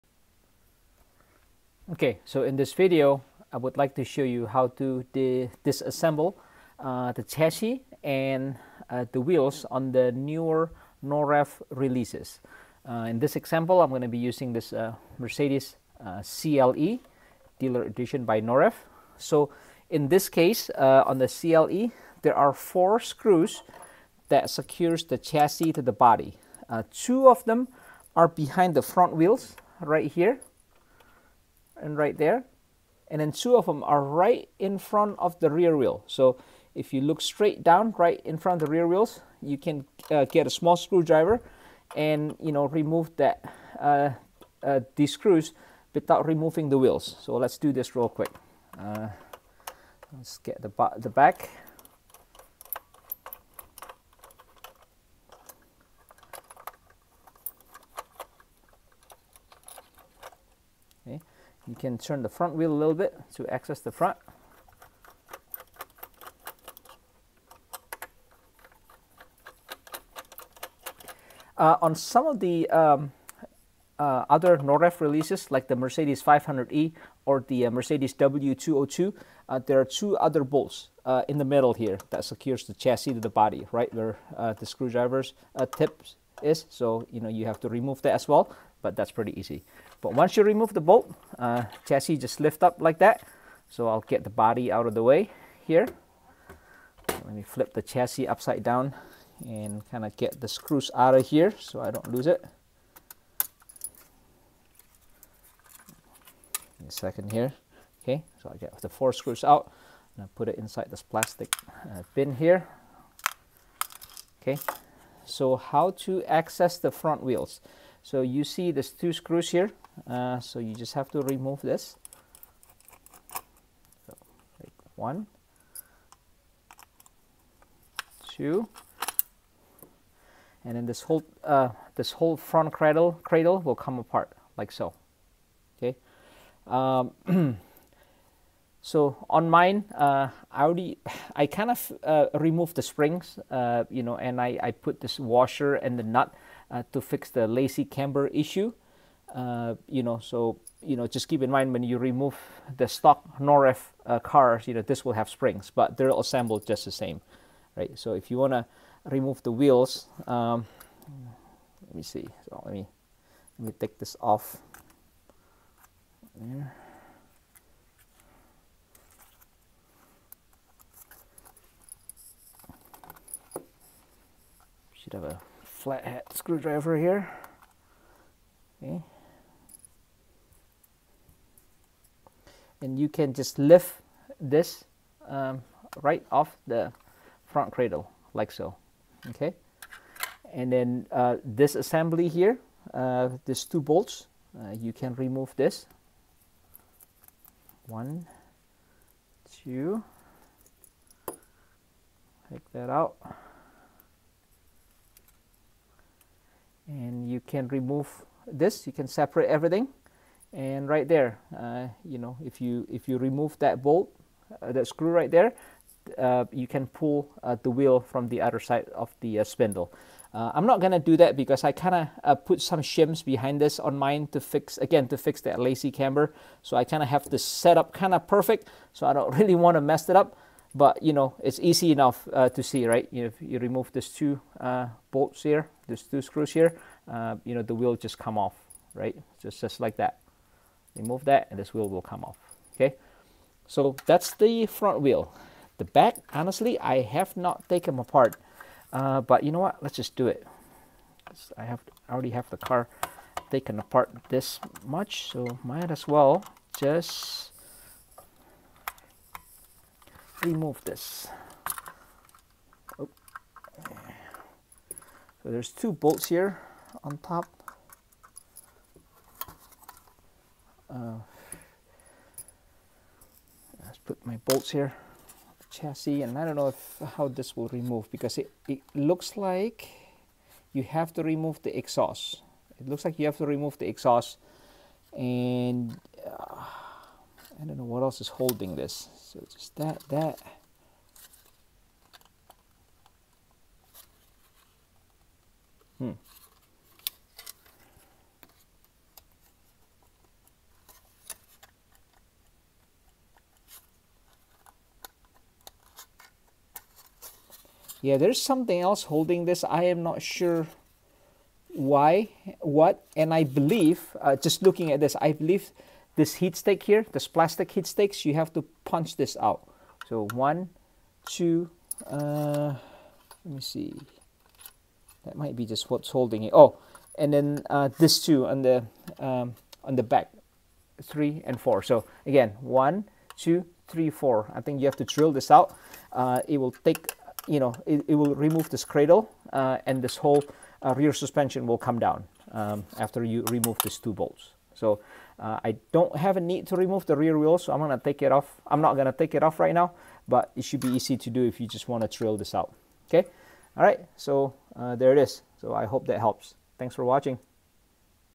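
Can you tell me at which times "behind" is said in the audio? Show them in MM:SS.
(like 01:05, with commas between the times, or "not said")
00:28, 03:43.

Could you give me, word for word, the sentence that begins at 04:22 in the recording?
So there's two bolts here on top.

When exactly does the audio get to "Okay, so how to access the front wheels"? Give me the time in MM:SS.
01:54.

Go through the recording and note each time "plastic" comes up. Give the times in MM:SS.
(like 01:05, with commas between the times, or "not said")
01:51, 05:17.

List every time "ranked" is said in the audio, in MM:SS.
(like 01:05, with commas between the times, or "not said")
not said.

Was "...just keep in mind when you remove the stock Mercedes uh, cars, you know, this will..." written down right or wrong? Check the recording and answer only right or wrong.
wrong.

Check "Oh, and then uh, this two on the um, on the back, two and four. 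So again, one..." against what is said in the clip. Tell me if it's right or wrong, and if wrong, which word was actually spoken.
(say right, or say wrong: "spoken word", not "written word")
wrong: "three", not "two".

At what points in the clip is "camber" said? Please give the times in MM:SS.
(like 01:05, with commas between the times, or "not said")
02:27, 03:45.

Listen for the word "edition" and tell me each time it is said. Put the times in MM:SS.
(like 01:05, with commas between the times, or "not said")
00:17.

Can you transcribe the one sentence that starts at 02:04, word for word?
So, like one, two, and then this whole uh, this whole front cradle cradle will come apart like so.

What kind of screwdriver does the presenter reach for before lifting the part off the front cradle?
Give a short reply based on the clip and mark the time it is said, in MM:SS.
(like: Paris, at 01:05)
flathead, at 02:55.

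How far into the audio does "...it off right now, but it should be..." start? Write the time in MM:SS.
05:49.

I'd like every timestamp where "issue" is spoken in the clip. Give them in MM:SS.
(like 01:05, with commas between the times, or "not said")
02:28.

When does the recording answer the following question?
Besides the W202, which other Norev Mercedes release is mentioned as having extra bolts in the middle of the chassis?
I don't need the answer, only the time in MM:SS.
01:15.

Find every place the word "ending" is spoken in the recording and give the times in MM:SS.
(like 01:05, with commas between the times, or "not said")
not said.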